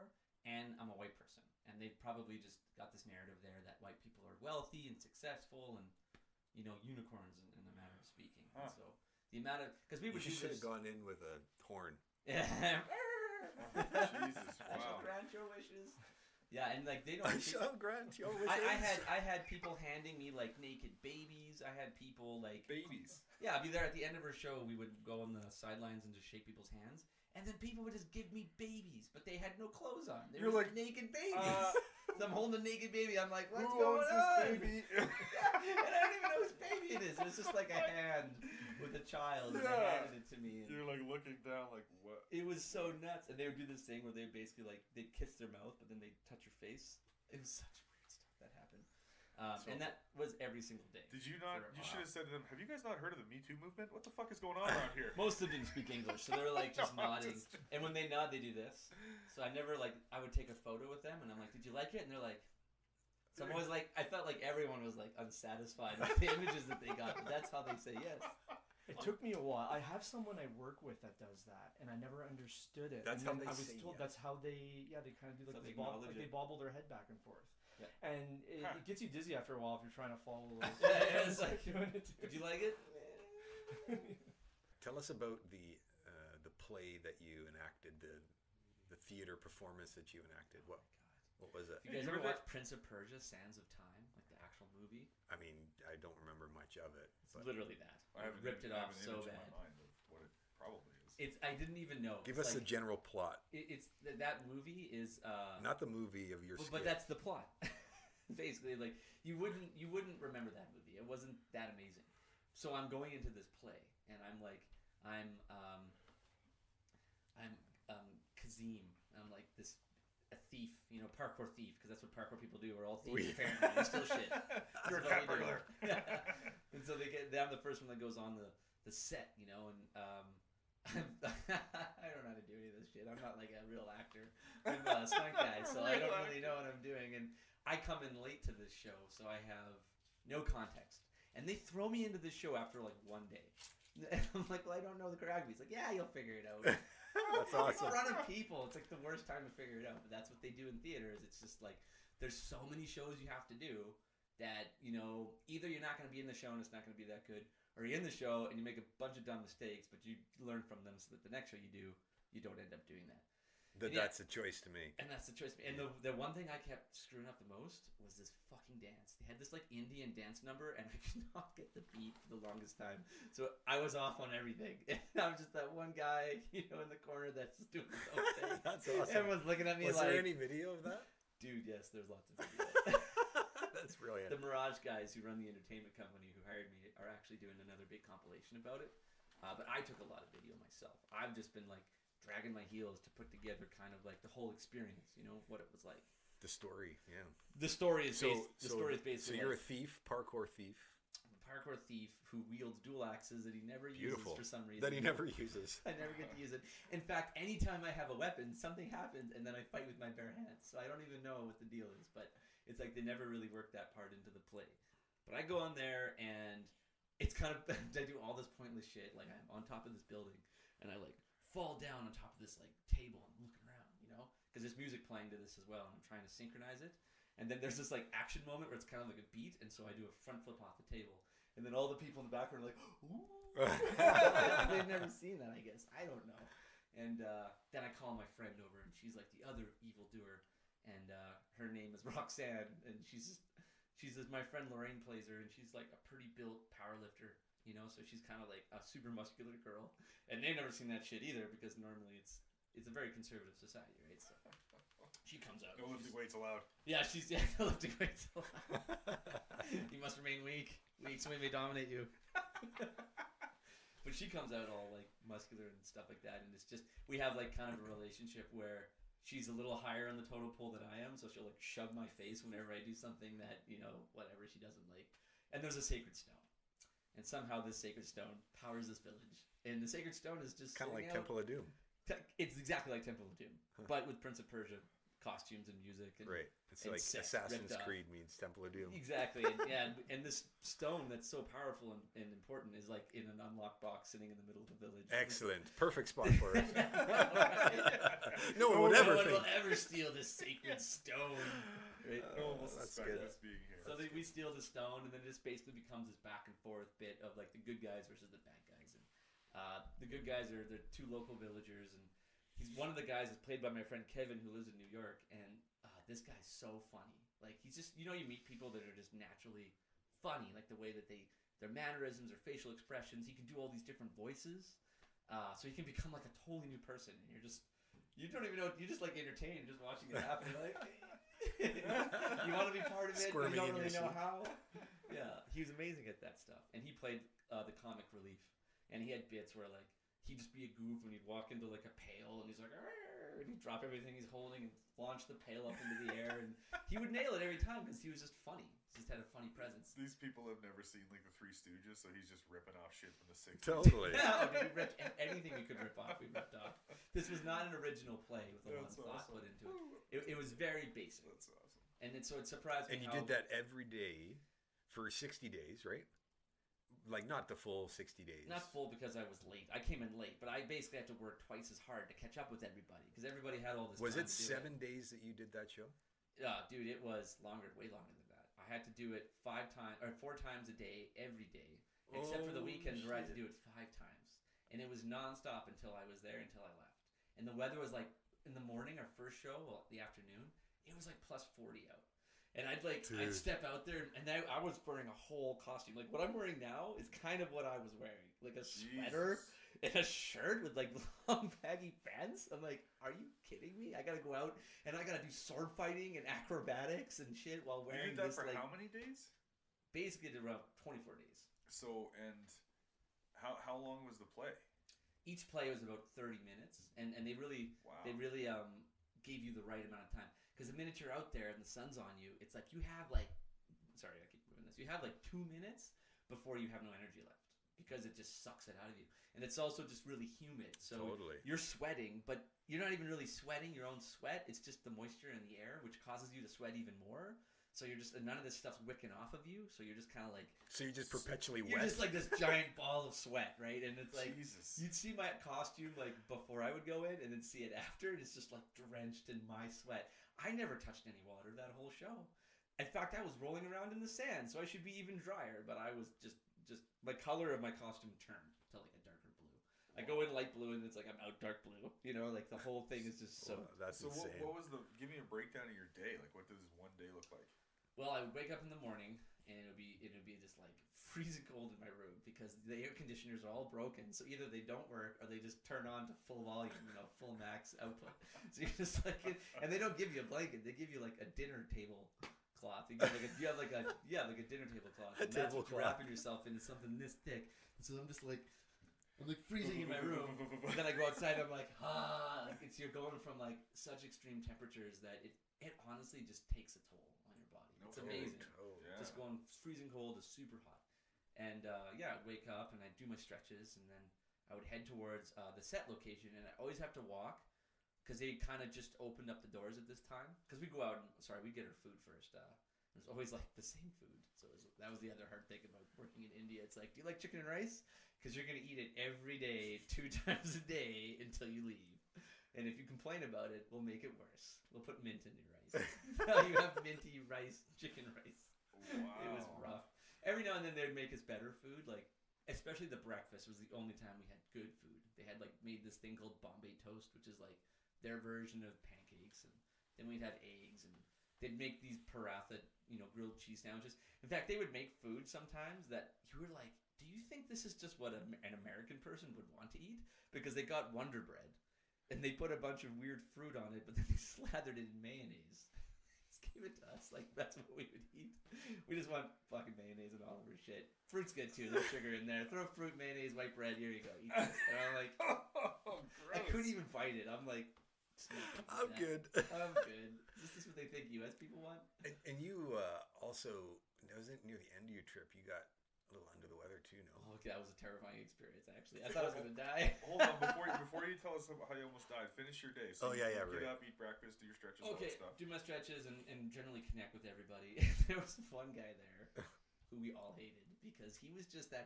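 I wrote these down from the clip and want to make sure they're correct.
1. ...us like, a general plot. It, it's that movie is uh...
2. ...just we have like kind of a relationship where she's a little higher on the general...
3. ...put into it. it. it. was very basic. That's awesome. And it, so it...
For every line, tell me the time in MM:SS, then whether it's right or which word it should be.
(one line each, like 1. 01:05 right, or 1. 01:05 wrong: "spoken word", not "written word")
1. 01:42 right
2. 04:26 wrong: "total", not "general"
3. 05:59 right.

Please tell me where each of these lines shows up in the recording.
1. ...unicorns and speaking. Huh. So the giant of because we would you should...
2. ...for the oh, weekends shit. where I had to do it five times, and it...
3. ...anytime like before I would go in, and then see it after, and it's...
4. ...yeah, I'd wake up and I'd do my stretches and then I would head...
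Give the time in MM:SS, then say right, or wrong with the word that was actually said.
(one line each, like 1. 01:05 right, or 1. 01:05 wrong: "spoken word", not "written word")
1. 00:06 wrong: "amount", not "giant"
2. 06:22 right
3. 07:25 wrong: "costume", not "anytime"
4. 08:21 right.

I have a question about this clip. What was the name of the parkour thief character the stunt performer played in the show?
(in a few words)
Kazim.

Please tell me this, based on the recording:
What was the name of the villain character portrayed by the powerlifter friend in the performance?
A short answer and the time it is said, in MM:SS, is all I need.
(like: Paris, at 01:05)
Roxanne, at 04:02.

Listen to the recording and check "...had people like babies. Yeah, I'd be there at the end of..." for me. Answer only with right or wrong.
right.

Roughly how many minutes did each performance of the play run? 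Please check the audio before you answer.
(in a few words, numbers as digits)
30.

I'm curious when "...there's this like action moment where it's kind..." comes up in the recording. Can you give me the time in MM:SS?
03:47.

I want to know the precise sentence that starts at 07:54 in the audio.
So either they don't work or they just turn on to full volume, you know, full max output.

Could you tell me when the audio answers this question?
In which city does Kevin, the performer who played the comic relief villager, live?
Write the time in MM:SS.
05:14.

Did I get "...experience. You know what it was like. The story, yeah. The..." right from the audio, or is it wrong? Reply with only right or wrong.
right.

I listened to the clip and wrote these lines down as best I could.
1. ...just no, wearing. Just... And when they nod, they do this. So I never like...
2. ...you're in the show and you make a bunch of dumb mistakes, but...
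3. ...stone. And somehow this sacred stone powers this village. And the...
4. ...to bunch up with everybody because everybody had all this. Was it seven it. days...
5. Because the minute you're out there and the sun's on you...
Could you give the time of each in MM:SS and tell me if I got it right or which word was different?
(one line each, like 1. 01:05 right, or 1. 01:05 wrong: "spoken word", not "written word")
1. 00:56 wrong: "nodding", not "wearing"
2. 02:37 right
3. 04:36 right
4. 06:12 wrong: "catch", not "bunch"
5. 07:00 right.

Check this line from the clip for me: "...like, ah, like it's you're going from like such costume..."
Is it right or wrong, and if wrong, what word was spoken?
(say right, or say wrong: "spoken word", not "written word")
wrong: "extreme", not "costume".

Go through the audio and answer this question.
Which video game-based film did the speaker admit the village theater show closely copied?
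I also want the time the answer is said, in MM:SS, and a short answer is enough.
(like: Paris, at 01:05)
Prince of Persia: Sands of Time, at 01:32.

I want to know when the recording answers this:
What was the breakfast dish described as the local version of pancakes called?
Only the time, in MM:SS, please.
08:56.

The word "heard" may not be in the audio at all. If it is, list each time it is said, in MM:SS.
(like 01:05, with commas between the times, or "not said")
00:53.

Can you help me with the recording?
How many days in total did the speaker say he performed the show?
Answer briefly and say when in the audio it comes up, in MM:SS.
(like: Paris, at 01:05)
24, at 06:50.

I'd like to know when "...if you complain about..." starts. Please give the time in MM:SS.
08:42.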